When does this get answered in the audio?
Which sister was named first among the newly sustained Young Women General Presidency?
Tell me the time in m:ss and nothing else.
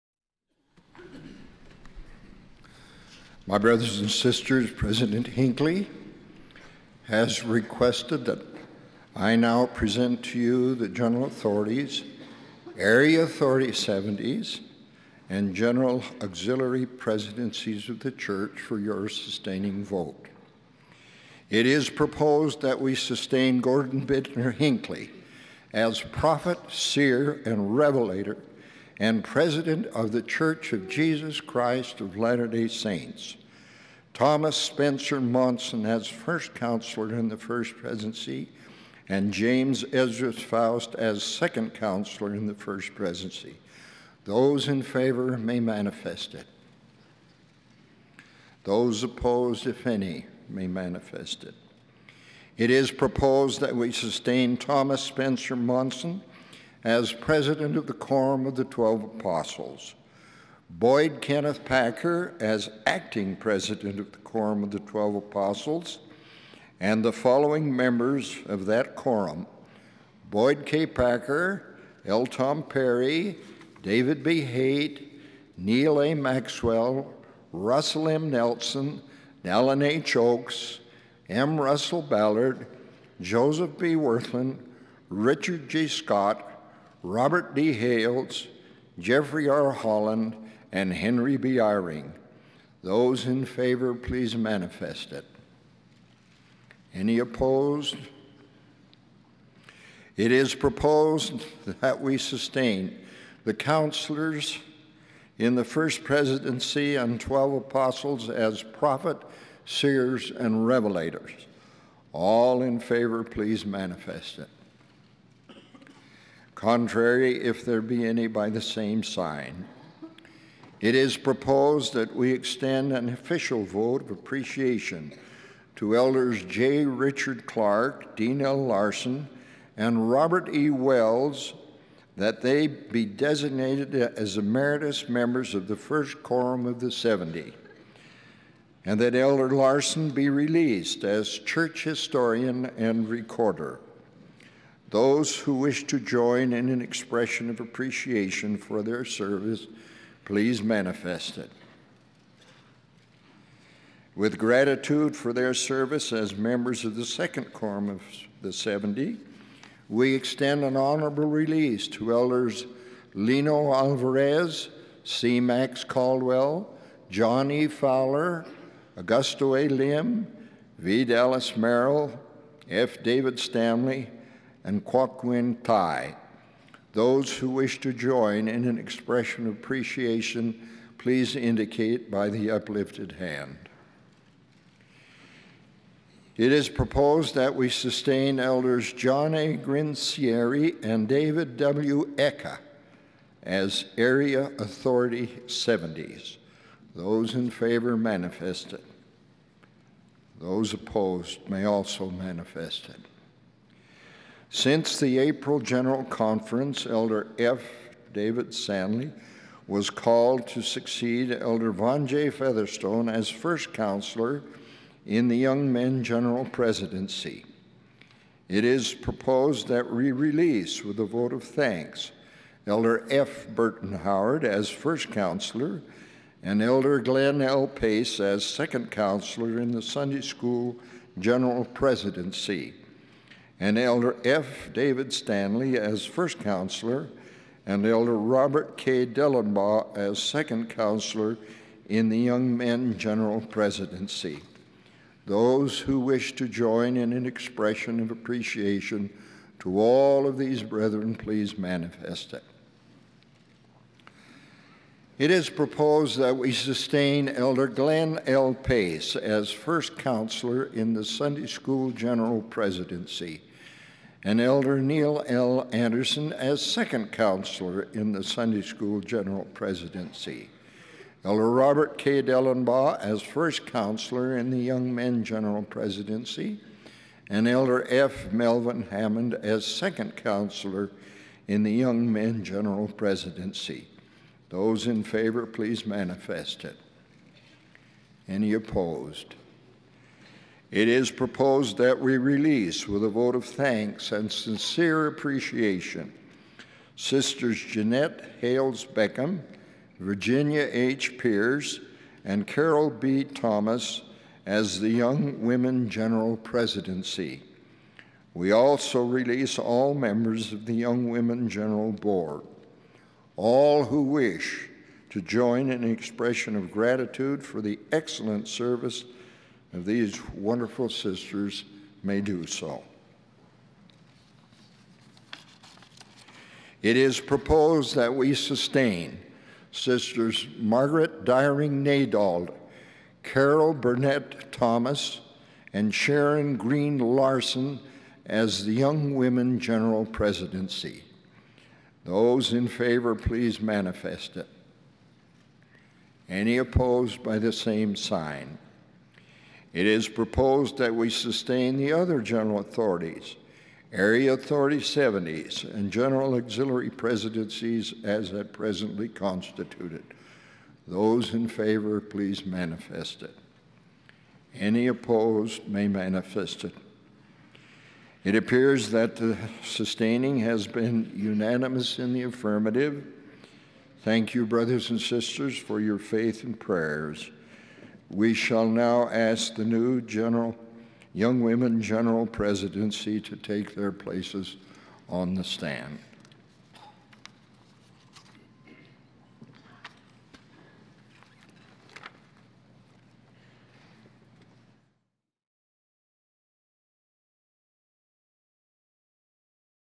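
5:30.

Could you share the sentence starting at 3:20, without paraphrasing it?
Those opposed may also manifest it.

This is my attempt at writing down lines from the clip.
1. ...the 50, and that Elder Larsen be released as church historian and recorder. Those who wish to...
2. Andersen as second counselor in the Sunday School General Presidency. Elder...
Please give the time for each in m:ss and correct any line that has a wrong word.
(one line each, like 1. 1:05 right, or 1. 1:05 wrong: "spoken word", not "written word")
1. 2:16 wrong: "70", not "50"
2. 4:25 right.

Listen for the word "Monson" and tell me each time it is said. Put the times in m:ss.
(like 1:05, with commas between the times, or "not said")
0:35, 0:55.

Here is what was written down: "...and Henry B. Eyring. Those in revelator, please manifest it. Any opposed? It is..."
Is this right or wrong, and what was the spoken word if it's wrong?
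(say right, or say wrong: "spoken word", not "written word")
wrong: "favor", not "revelator".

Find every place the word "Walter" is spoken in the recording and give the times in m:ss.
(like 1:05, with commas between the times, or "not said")
not said.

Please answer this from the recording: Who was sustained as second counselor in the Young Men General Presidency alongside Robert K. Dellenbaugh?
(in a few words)
F. Melvin Hammond.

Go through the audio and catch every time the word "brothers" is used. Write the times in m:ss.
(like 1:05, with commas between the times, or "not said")
0:03, 6:14.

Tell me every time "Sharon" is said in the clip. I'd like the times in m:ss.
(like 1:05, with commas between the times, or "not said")
5:35.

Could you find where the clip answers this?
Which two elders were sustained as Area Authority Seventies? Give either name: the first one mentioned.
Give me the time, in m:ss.
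3:08.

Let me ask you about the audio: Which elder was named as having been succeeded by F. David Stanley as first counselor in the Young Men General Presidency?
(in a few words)
Vaughn J. Featherstone.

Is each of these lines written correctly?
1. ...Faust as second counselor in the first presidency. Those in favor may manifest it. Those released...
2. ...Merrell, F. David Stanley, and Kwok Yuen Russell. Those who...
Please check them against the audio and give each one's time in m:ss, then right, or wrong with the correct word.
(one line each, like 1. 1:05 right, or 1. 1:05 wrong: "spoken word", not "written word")
1. 0:40 wrong: "opposed", not "released"
2. 2:51 wrong: "Tai", not "Russell".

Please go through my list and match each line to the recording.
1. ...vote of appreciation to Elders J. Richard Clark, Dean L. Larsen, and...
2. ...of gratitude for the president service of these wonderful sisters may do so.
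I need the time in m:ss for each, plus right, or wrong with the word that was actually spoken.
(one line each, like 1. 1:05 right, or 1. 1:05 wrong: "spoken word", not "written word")
1. 2:03 right
2. 5:16 wrong: "excellent", not "president".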